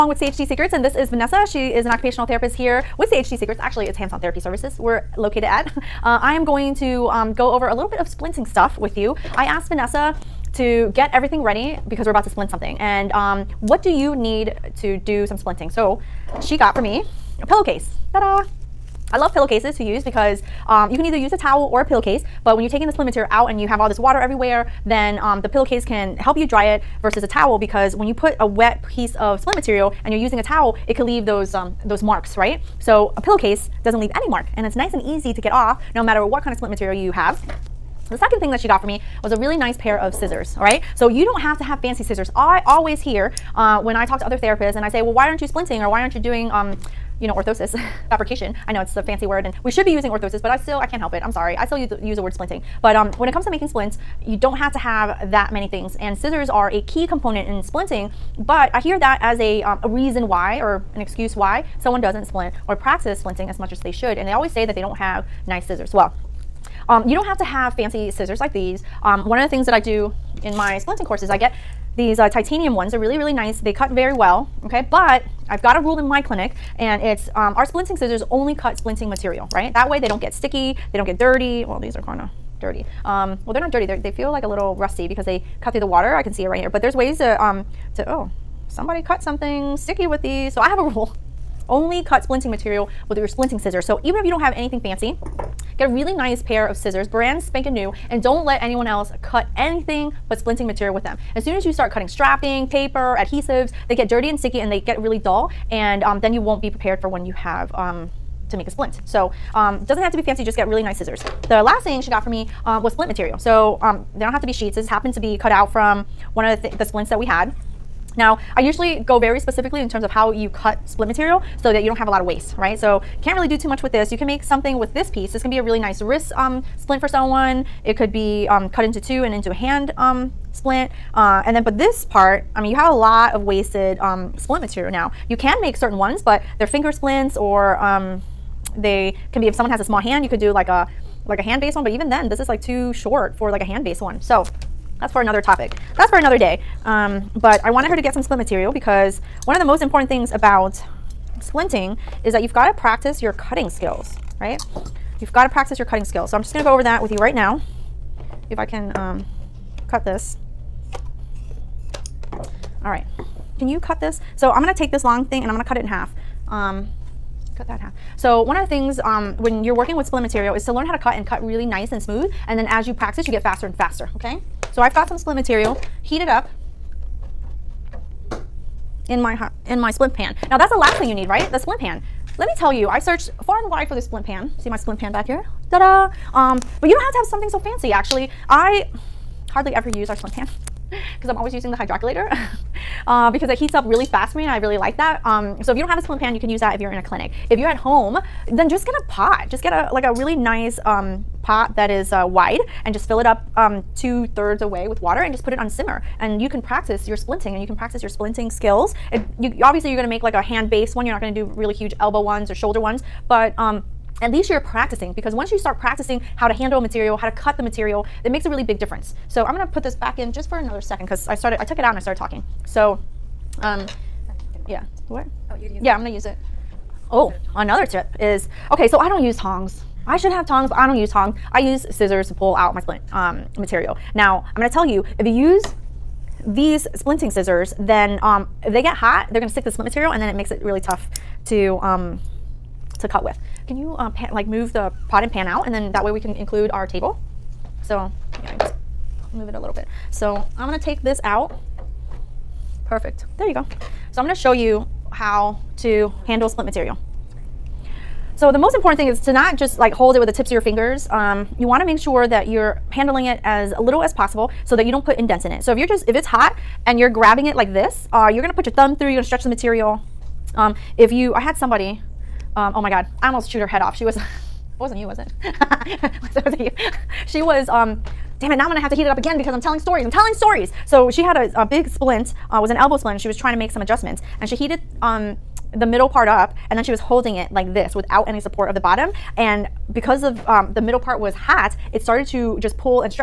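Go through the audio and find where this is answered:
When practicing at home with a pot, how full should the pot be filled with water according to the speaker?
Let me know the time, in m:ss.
3:23.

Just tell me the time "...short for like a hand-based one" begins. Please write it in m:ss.
2:22.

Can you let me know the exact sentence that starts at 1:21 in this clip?
Well, these are kind of dirty.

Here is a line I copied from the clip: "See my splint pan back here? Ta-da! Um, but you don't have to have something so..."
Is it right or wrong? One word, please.
right.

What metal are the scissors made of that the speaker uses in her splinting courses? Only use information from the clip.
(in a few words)
Titanium.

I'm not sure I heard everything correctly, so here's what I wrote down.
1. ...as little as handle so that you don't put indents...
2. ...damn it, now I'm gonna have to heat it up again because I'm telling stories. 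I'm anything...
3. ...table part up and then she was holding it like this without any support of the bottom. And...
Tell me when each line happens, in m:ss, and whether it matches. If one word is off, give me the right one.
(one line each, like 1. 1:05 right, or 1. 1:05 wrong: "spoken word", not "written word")
1. 4:23 wrong: "possible", not "handle"
2. 4:38 wrong: "telling", not "anything"
3. 4:45 wrong: "middle", not "table".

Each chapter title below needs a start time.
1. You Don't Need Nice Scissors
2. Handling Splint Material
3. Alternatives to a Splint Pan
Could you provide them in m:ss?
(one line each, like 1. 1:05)
1. 1:07
2. 4:20
3. 3:05.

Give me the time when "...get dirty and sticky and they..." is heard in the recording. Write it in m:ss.
1:43.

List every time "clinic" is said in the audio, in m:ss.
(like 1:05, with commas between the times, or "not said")
1:16, 3:17.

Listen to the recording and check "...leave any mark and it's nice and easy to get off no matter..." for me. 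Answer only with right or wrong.
right.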